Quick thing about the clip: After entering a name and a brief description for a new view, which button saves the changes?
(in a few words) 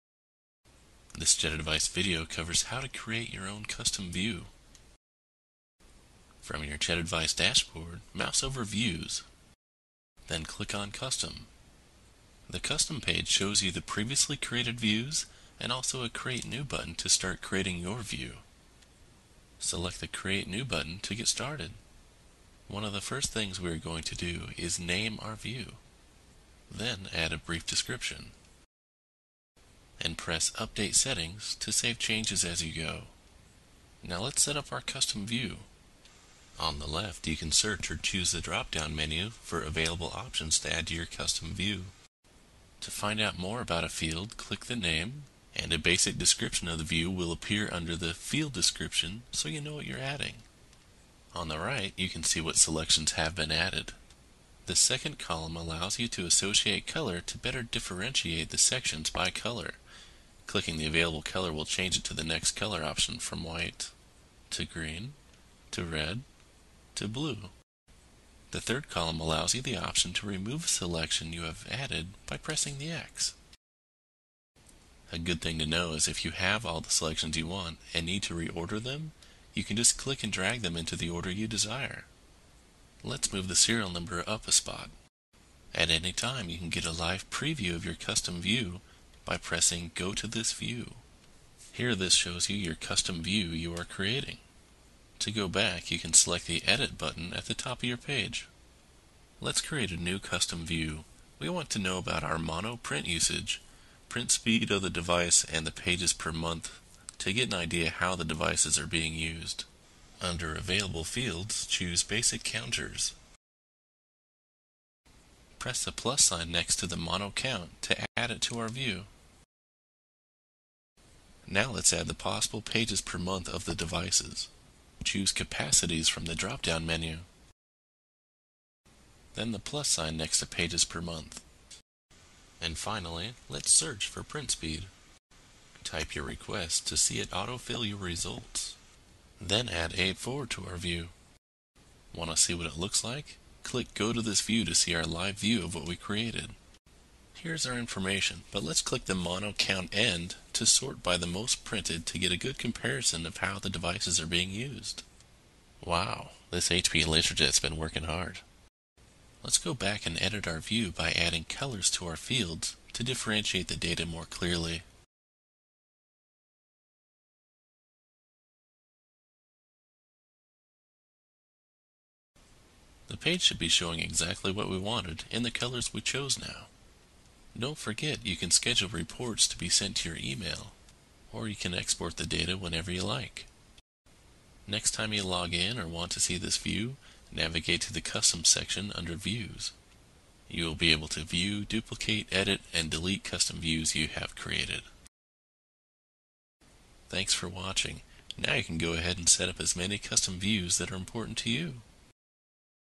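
Update Settings.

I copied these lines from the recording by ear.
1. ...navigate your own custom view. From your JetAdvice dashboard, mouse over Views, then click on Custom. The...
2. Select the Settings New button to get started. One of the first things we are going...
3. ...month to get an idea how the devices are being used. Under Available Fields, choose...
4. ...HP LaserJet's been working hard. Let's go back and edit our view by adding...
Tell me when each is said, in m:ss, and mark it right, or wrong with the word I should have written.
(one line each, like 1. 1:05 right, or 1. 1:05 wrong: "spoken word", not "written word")
1. 0:02 wrong: "create", not "navigate"
2. 0:19 wrong: "Create", not "Settings"
3. 1:46 right
4. 2:36 right.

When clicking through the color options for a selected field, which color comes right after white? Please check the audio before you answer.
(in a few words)
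green.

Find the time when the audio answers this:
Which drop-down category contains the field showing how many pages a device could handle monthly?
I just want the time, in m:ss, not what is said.
2:05.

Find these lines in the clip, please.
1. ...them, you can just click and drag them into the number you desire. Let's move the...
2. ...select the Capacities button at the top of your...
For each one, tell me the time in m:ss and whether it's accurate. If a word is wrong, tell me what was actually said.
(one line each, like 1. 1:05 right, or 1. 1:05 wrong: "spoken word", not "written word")
1. 1:18 wrong: "order", not "number"
2. 1:36 wrong: "Edit", not "Capacities".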